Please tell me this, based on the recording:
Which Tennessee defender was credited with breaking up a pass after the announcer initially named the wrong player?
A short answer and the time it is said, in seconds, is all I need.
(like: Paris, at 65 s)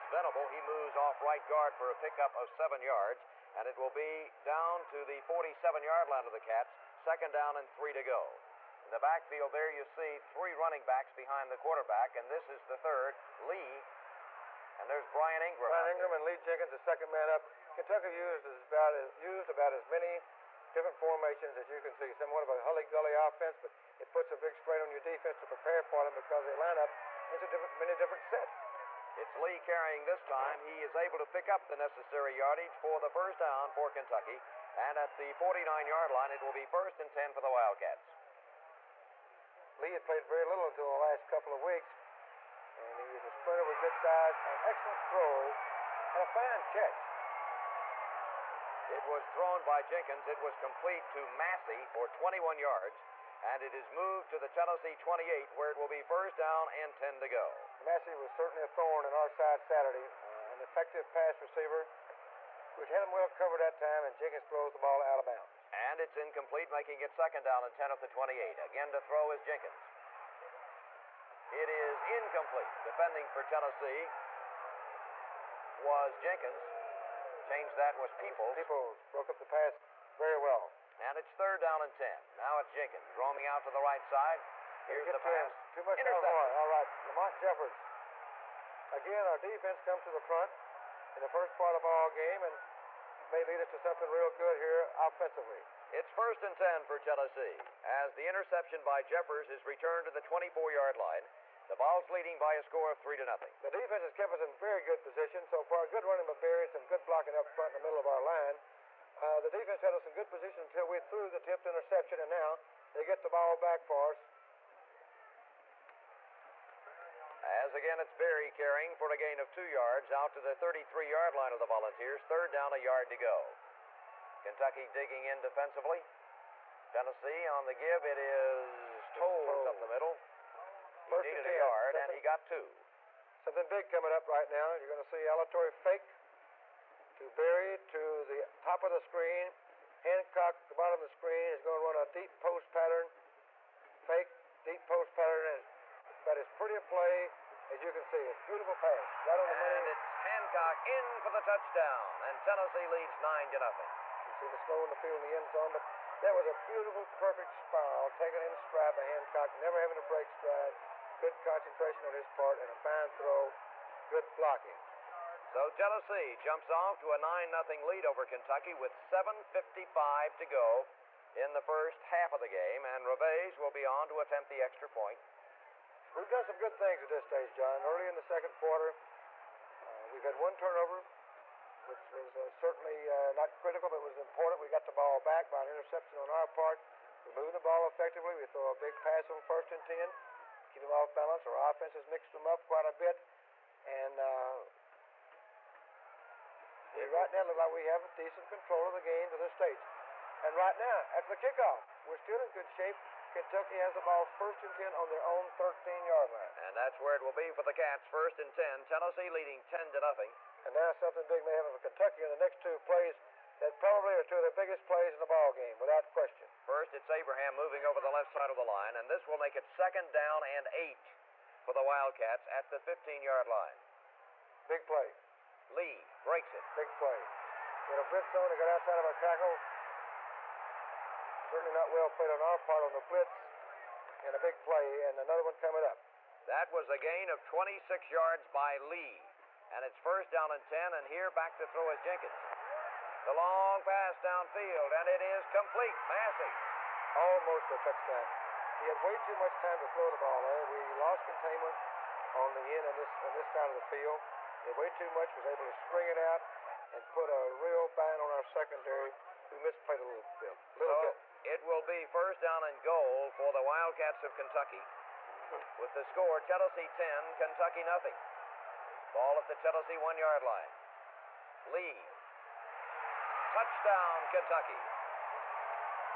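Peoples, at 78 s.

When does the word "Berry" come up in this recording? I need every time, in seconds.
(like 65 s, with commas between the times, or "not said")
106 s, 118 s, 137 s.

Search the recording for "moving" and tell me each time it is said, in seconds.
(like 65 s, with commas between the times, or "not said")
187 s, 217 s.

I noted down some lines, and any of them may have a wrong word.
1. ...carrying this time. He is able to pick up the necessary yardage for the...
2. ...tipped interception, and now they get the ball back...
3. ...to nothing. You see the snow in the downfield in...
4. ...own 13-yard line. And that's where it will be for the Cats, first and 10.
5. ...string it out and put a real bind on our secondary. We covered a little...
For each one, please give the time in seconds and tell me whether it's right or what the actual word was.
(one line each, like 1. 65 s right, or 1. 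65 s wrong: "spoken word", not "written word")
1. 29 s right
2. 111 s right
3. 153 s wrong: "field", not "downfield"
4. 205 s right
5. 255 s wrong: "misplayed", not "covered".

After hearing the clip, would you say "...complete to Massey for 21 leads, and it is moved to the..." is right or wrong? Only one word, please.
wrong.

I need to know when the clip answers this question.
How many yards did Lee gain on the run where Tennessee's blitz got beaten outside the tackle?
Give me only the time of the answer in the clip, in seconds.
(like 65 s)
237 s.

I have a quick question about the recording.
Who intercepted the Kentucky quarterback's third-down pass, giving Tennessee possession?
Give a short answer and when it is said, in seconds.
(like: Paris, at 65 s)
Lamont Jeffers, at 87 s.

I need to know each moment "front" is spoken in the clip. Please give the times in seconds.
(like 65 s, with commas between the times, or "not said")
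90 s, 107 s.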